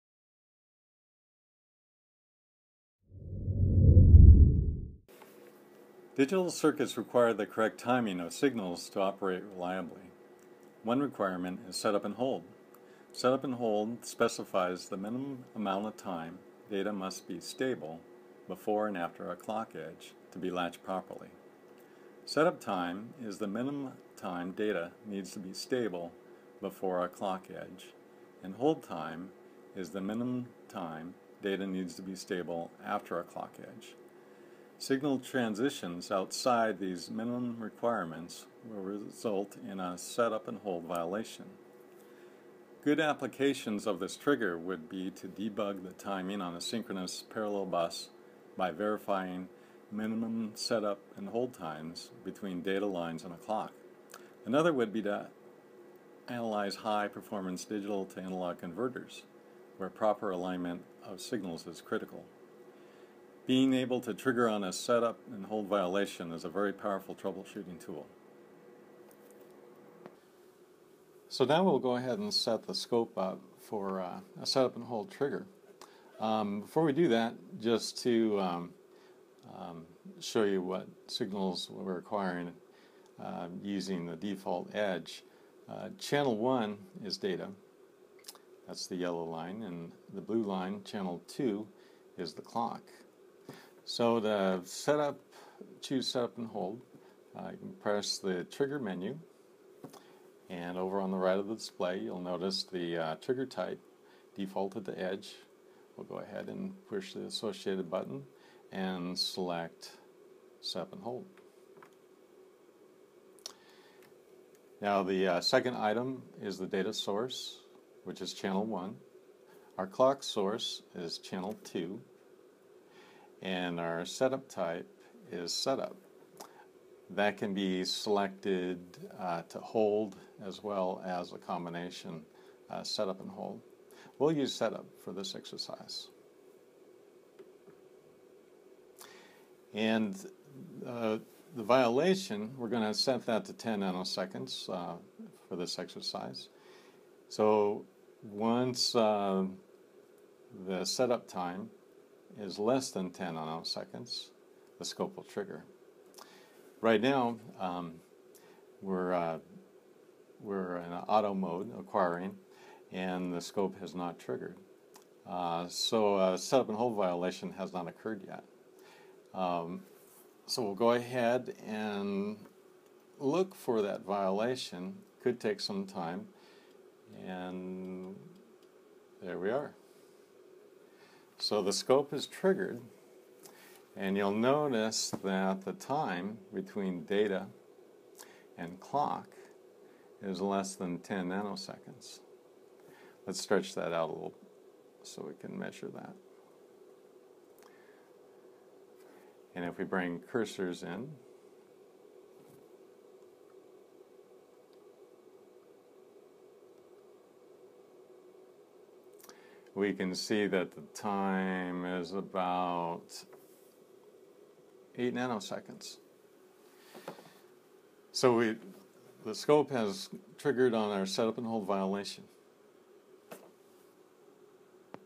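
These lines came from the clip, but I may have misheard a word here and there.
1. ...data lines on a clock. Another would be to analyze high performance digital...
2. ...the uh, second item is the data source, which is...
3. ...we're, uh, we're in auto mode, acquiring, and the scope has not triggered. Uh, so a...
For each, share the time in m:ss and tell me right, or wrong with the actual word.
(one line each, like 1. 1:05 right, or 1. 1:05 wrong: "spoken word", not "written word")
1. 0:52 right
2. 1:55 right
3. 2:38 right.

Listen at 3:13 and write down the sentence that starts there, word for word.
Let's stretch that out a little so we can measure that.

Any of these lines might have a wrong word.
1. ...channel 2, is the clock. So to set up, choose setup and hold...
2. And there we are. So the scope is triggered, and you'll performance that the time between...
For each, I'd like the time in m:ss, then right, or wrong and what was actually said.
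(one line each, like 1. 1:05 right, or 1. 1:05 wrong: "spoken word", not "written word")
1. 1:30 right
2. 2:57 wrong: "notice", not "performance".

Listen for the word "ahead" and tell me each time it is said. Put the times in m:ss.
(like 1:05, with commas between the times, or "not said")
1:11, 1:46, 2:50.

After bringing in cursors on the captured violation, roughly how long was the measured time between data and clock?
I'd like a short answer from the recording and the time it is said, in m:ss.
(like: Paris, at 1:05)
About 8 nanoseconds, at 3:32.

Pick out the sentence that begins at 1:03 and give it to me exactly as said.
Being able to trigger on a setup and hold violation is a very powerful troubleshooting tool.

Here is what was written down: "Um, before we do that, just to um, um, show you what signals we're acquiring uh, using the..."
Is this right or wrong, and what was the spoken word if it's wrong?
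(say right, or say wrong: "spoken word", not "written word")
right.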